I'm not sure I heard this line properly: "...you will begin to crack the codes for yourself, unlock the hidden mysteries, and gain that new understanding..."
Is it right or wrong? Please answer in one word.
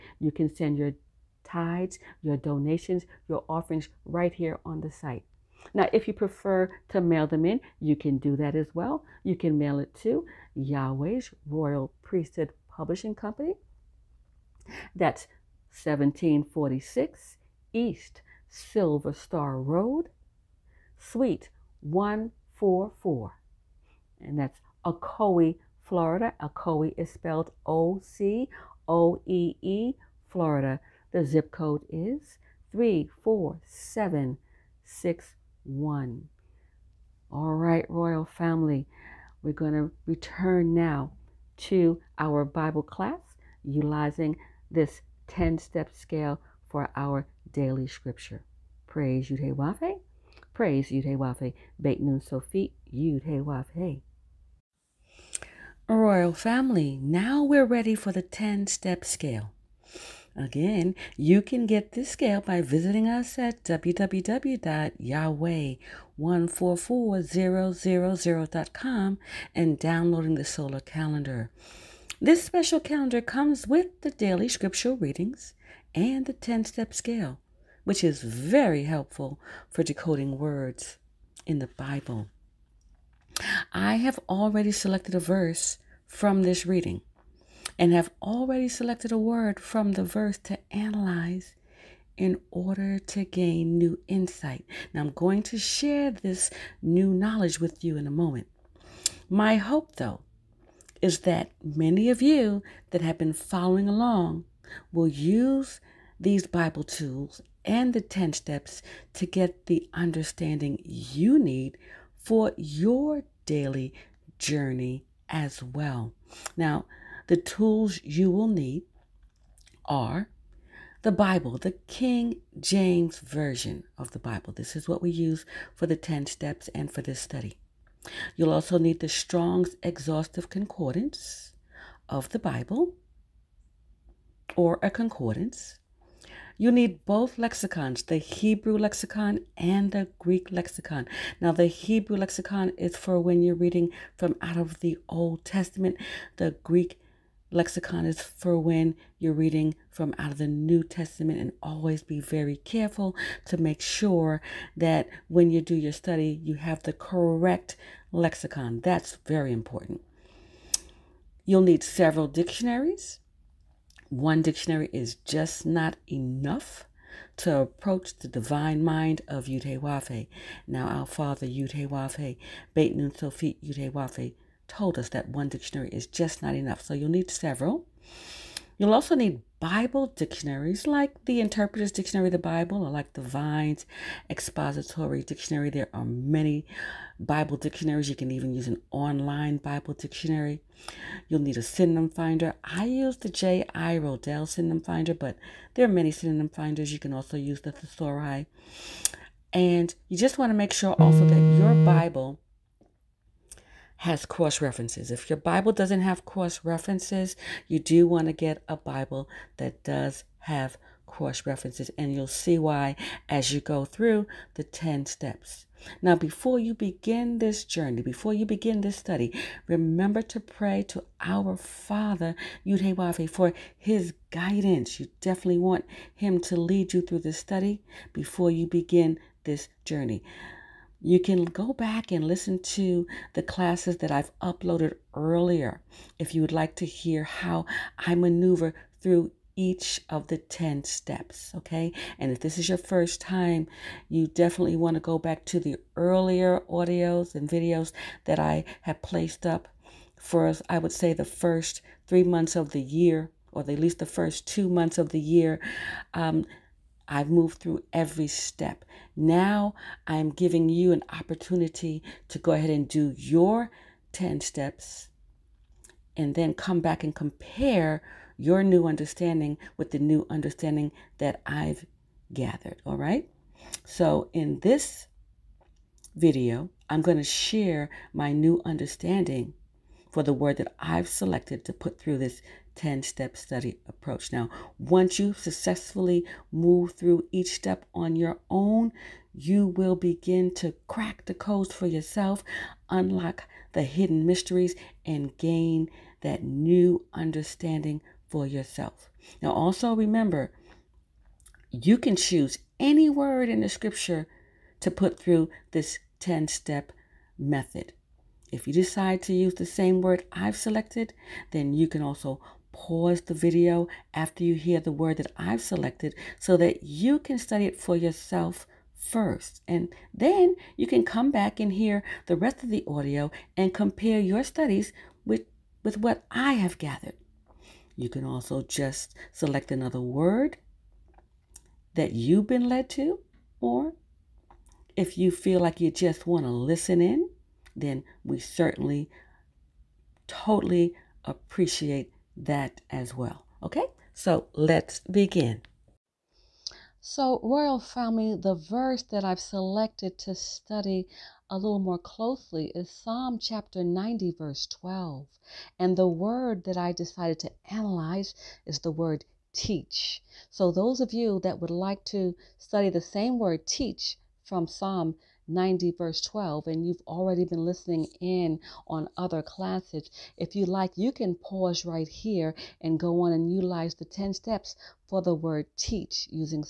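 right.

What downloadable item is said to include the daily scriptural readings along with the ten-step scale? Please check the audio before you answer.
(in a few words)
solar calendar.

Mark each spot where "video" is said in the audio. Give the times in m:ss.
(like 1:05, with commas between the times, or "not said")
4:07, 4:36, 5:13.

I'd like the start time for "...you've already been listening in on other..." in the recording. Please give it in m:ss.
6:06.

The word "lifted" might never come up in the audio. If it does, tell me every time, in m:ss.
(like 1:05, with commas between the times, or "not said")
not said.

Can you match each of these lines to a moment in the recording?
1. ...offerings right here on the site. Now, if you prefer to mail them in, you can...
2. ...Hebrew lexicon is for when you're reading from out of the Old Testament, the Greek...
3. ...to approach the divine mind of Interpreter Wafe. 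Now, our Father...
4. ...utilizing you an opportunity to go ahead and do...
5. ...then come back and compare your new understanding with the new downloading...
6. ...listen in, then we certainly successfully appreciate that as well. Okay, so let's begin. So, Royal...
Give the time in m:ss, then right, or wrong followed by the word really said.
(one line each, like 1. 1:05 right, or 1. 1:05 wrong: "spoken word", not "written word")
1. 0:03 right
2. 2:21 right
3. 2:47 wrong: "Yudhe", not "Interpreter"
4. 4:20 wrong: "giving", not "utilizing"
5. 4:26 wrong: "understanding", not "downloading"
6. 5:36 wrong: "totally", not "successfully".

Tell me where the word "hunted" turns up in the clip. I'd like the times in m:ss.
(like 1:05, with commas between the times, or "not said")
not said.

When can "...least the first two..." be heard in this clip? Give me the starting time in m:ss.
4:13.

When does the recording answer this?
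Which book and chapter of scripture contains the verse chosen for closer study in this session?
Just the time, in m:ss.
5:52.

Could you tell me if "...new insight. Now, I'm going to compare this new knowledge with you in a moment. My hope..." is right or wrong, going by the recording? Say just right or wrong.
wrong.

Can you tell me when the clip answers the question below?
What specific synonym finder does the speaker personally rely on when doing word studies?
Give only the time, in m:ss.
3:13.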